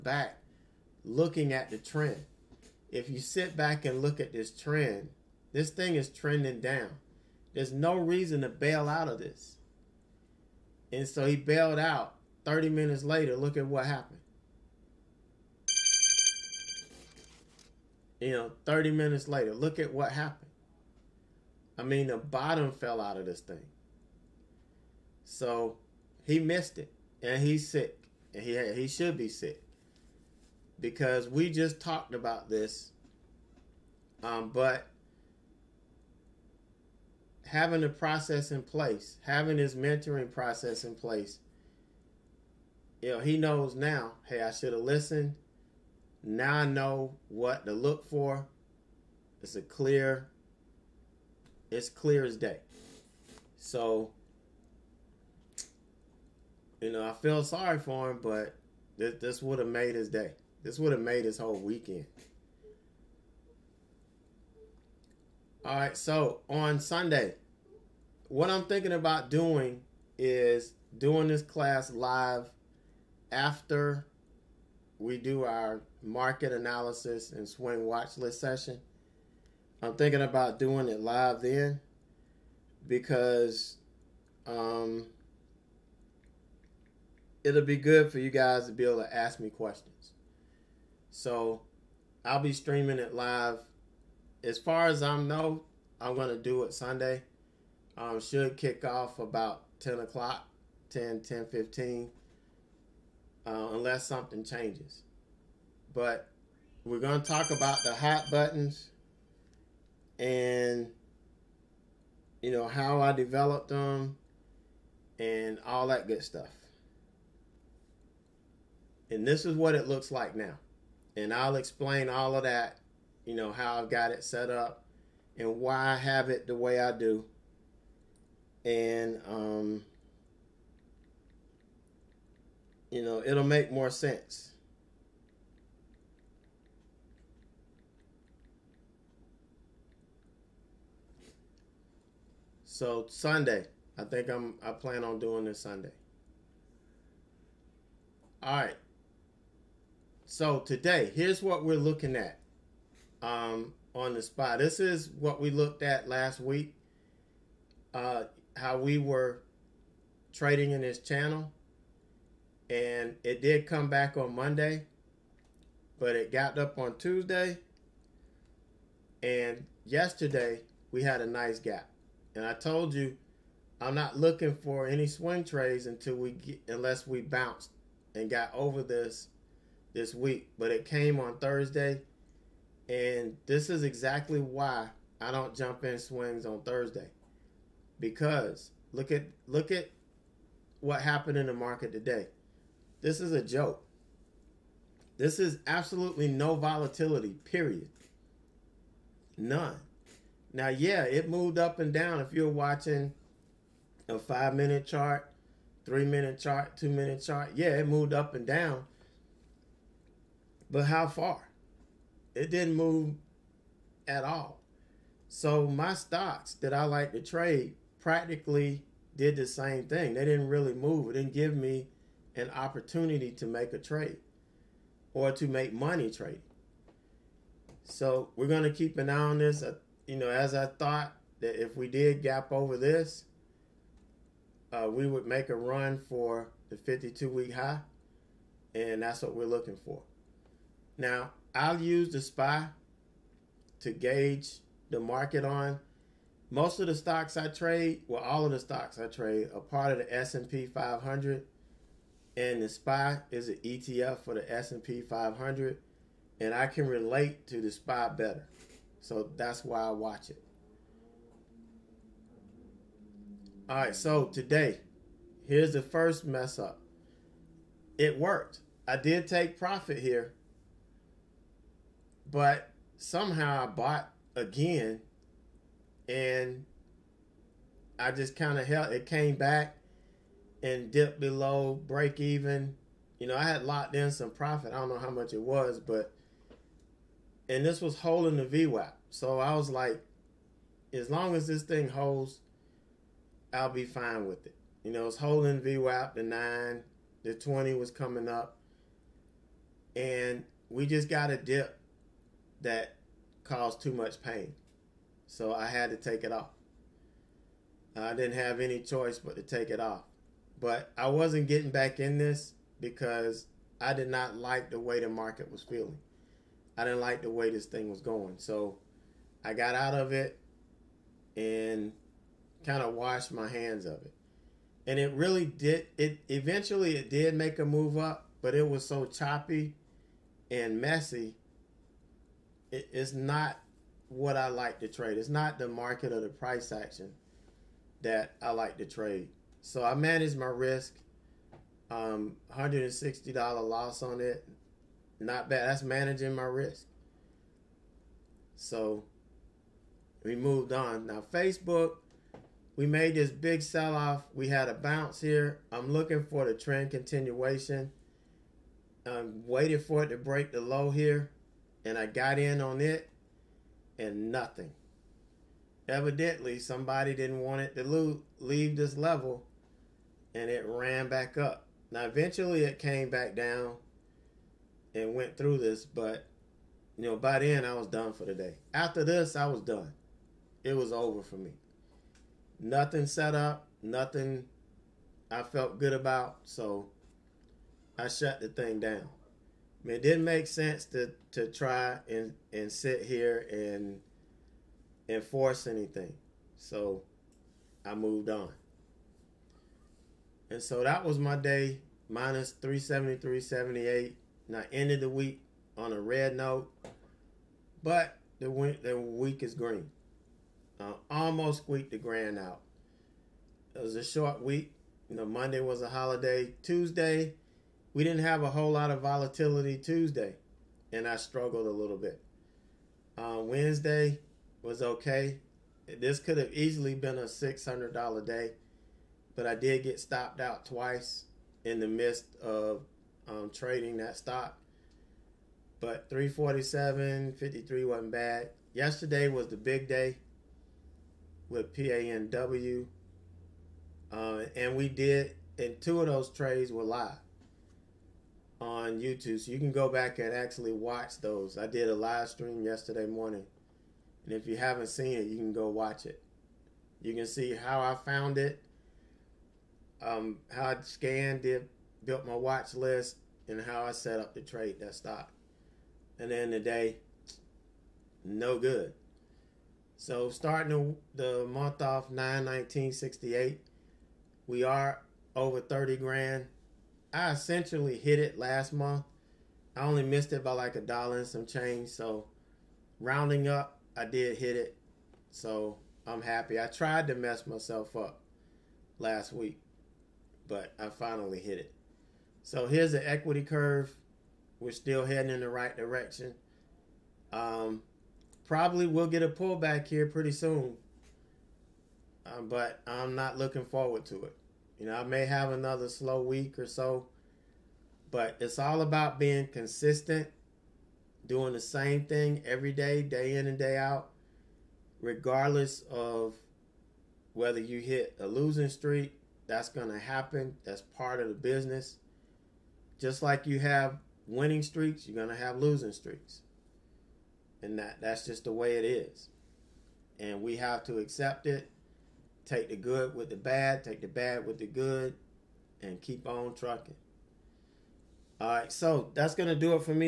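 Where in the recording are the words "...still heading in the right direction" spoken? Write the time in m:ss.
8:14.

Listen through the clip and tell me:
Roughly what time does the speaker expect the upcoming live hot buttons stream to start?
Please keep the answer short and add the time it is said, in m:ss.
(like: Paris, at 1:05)
10 o'clock, at 1:39.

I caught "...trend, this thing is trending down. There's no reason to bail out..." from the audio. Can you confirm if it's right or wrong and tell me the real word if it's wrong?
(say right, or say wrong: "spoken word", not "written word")
right.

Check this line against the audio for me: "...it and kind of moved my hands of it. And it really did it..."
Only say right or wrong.
wrong.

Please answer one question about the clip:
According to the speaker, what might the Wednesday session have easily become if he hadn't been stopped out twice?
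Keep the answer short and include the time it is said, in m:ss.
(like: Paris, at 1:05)
$600 day, at 7:07.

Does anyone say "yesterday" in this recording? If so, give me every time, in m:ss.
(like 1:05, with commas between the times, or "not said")
2:49, 7:18, 7:32.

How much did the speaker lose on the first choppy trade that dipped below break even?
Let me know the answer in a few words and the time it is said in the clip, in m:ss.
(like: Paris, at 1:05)
$160, at 5:42.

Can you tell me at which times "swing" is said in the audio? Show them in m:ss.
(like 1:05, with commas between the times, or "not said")
1:17, 2:55, 3:05.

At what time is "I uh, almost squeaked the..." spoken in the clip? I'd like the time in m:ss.
6:50.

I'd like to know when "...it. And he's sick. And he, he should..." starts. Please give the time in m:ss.
0:26.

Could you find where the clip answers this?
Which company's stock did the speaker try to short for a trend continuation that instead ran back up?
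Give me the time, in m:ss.
5:51.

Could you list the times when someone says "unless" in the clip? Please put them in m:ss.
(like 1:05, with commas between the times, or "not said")
1:43, 2:56.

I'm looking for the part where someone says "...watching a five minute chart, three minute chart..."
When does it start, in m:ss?
3:22.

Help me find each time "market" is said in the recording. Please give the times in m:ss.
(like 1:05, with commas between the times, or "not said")
1:16, 3:11, 4:04, 5:15, 5:35.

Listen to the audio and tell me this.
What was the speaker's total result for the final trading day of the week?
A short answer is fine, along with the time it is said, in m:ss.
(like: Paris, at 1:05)
-373.78, at 6:42.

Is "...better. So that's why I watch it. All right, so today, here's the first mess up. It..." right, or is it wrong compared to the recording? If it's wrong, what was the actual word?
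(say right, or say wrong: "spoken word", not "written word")
right.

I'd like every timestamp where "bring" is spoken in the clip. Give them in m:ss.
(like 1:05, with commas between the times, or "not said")
not said.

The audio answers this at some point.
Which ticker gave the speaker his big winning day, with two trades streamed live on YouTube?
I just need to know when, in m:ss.
7:21.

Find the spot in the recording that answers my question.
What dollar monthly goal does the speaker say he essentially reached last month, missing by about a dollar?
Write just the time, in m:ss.
7:55.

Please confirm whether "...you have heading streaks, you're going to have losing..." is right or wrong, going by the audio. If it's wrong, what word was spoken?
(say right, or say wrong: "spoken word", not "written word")
wrong: "winning", not "heading".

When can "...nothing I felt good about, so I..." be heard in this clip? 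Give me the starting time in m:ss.
6:23.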